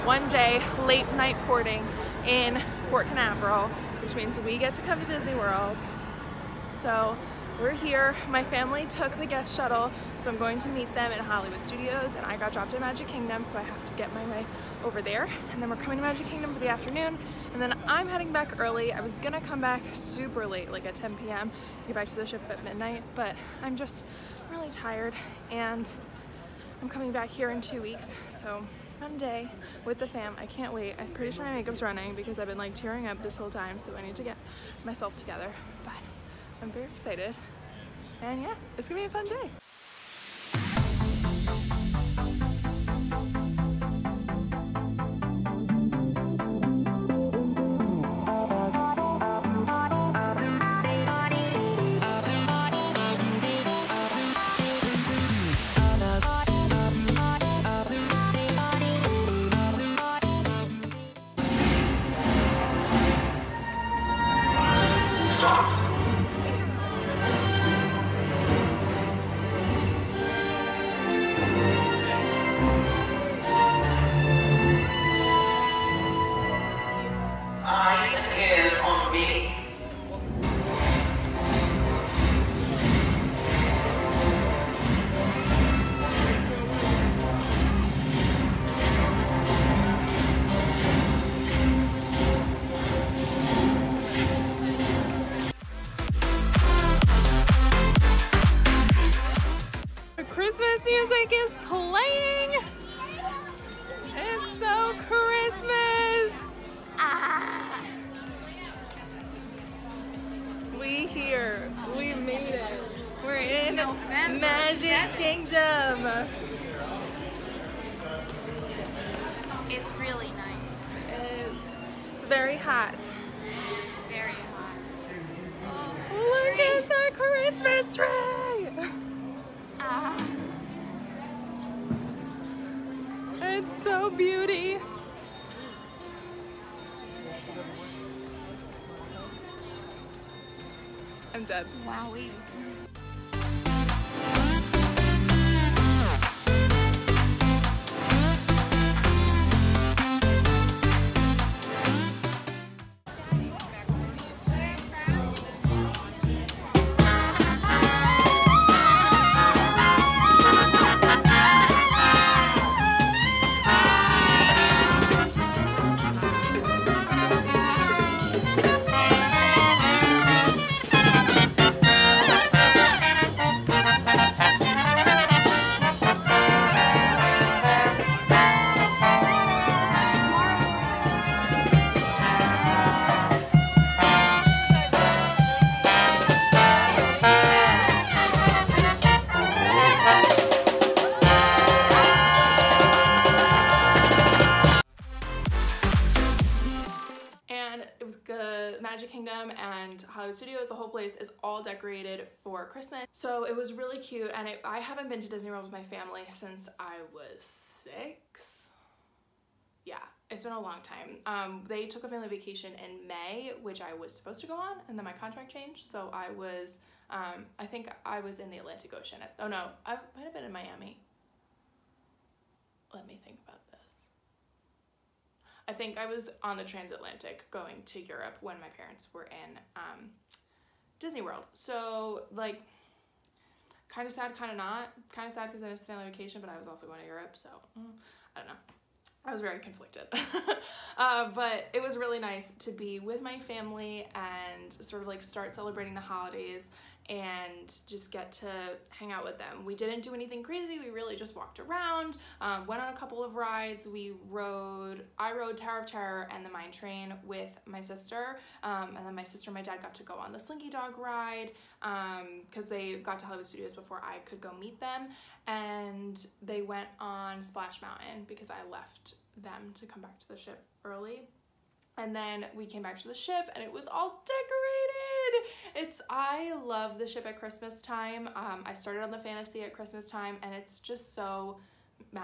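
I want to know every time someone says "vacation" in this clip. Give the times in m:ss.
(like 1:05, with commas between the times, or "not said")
3:32, 3:56.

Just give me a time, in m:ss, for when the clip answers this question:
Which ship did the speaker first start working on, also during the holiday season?
4:39.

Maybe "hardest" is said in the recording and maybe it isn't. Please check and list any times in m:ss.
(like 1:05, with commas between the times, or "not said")
not said.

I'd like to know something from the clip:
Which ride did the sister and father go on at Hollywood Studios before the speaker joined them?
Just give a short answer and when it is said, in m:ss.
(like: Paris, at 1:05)
Slinky Dog, at 4:20.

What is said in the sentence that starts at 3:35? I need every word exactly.
So I was, um, I think I was in the Atlantic Ocean.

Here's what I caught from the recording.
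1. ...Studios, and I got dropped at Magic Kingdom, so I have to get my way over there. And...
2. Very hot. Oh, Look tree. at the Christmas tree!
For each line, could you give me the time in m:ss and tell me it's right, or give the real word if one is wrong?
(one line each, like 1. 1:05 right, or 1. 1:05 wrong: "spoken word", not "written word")
1. 0:11 right
2. 2:04 right.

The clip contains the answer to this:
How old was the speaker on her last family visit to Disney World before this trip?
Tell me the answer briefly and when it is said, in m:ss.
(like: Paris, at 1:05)
6, at 3:27.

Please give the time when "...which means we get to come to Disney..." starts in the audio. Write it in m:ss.
0:04.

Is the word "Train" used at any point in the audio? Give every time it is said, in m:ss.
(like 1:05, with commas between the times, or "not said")
4:16.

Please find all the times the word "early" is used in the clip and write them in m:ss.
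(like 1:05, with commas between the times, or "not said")
0:18, 4:30.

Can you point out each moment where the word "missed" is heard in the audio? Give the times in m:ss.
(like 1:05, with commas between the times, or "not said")
3:55.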